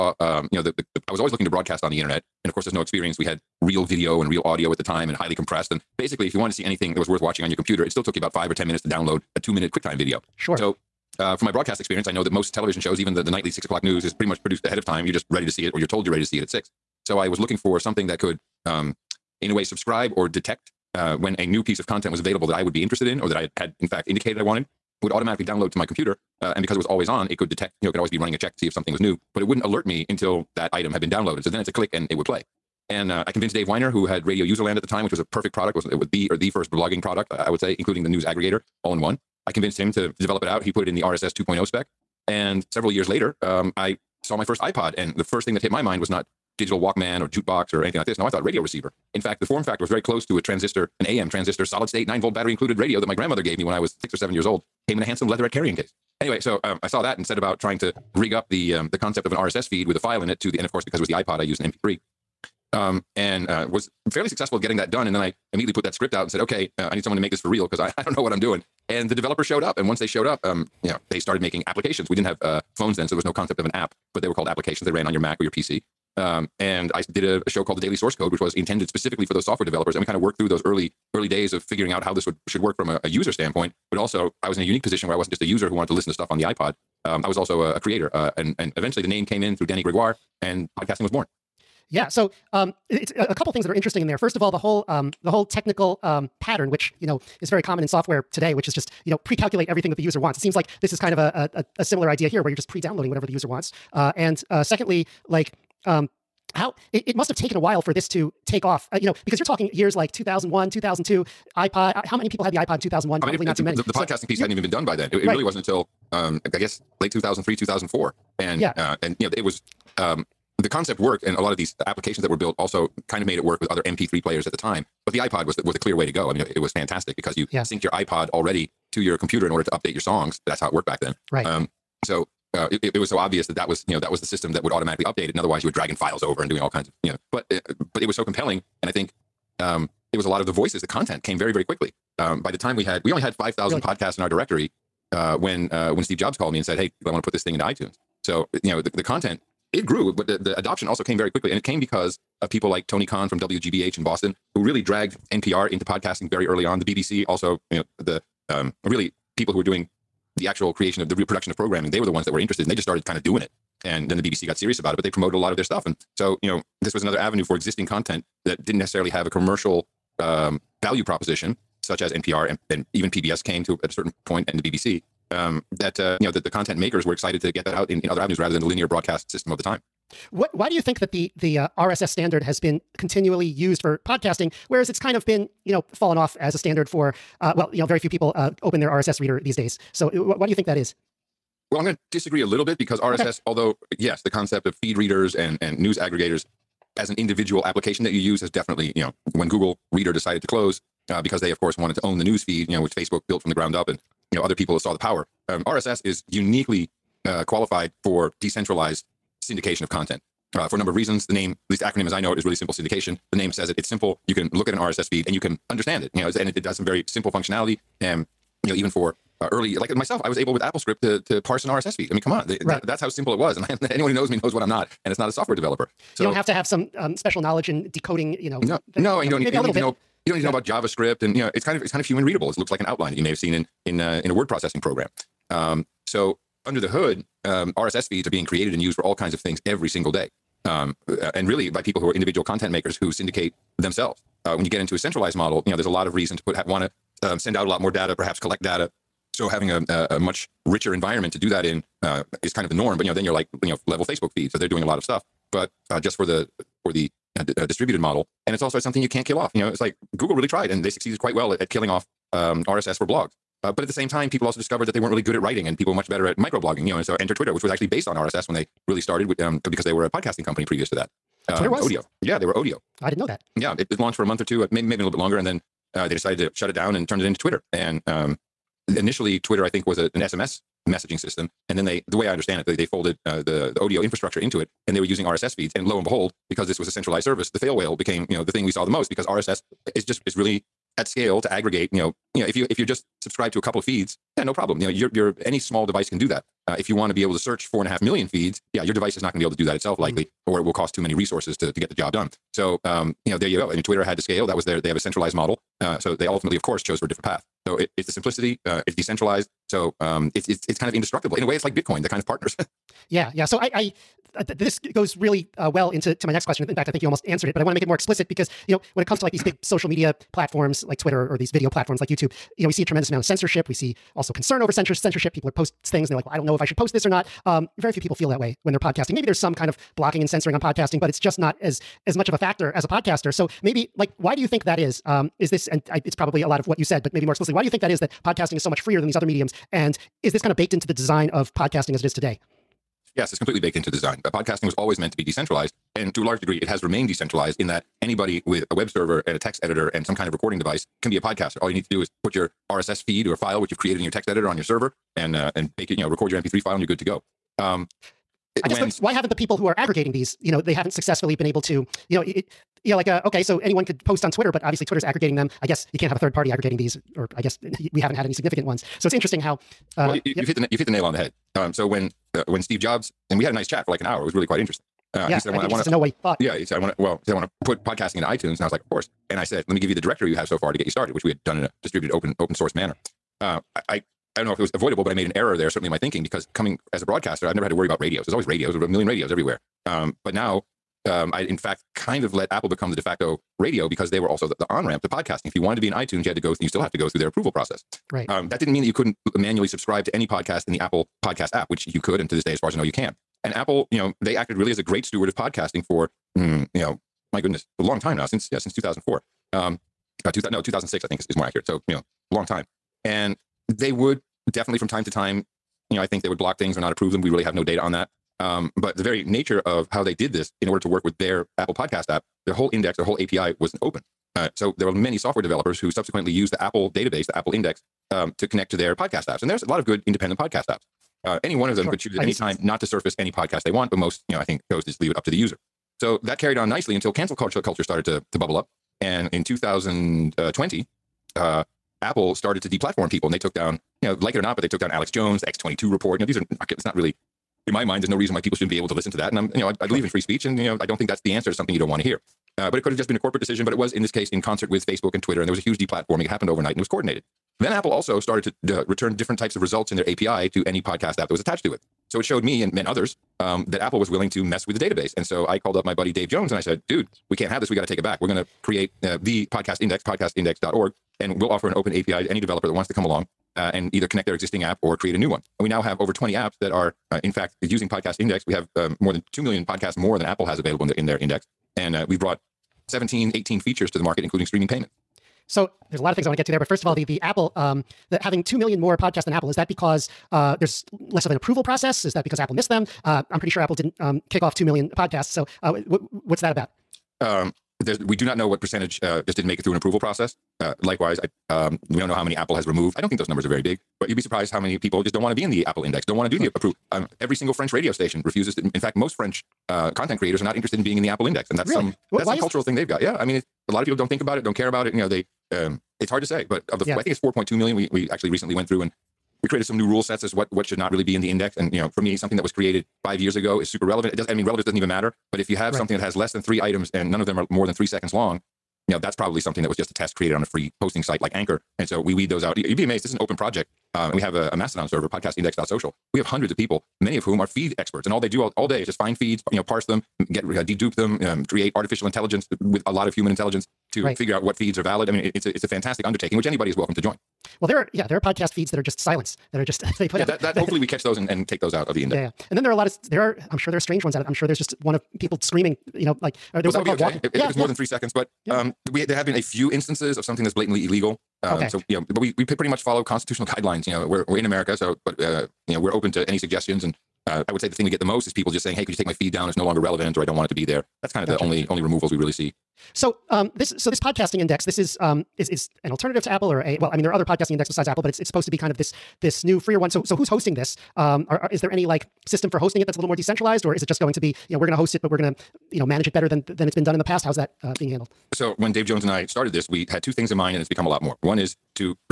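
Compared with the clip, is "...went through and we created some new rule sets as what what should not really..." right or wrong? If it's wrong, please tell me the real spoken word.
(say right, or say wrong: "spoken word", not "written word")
right.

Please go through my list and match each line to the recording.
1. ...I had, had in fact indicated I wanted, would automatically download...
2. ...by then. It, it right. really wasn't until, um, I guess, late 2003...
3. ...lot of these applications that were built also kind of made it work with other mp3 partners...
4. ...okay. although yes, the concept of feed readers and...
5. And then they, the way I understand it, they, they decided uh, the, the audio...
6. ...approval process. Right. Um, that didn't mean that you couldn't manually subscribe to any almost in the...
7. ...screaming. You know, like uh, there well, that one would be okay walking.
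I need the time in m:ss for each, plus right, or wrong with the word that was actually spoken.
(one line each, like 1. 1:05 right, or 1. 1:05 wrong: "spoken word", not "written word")
1. 0:23 right
2. 1:54 right
3. 2:01 wrong: "players", not "partners"
4. 3:13 right
5. 4:41 wrong: "folded", not "decided"
6. 6:37 wrong: "podcast", not "almost"
7. 9:15 right.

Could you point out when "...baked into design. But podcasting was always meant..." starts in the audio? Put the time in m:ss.
5:43.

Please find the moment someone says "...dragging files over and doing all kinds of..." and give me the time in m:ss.
2:15.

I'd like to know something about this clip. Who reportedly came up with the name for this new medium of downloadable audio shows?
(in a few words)
Dannie Gregoire.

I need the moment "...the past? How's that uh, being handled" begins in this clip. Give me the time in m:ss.
9:46.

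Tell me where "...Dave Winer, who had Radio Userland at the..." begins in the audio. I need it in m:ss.
0:33.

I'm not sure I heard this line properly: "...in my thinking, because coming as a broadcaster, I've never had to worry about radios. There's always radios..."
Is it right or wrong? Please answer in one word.
right.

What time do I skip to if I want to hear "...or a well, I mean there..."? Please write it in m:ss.
9:36.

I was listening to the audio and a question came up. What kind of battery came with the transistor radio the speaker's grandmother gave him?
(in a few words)
nine volt.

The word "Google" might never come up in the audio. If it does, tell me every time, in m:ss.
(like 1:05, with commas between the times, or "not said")
3:19, 4:20.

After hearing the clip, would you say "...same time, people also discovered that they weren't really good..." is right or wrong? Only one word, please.
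right.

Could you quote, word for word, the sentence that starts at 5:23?
We see also concern over censorship.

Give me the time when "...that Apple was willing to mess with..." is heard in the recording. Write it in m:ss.
7:43.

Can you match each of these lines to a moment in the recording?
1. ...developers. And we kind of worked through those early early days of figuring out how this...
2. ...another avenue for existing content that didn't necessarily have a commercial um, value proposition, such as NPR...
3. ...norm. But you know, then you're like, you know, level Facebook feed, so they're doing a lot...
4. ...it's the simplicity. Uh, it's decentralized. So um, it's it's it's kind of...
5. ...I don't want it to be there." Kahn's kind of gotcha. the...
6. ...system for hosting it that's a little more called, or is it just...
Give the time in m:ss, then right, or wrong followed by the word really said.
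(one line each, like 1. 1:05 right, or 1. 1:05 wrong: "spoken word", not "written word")
1. 1:19 right
2. 2:47 right
3. 4:12 right
4. 5:07 right
5. 9:30 wrong: "That", not "Kahn"
6. 9:42 wrong: "decentralized", not "called".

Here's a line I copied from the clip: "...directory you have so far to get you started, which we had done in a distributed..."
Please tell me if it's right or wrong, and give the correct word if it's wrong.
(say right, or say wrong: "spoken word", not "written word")
right.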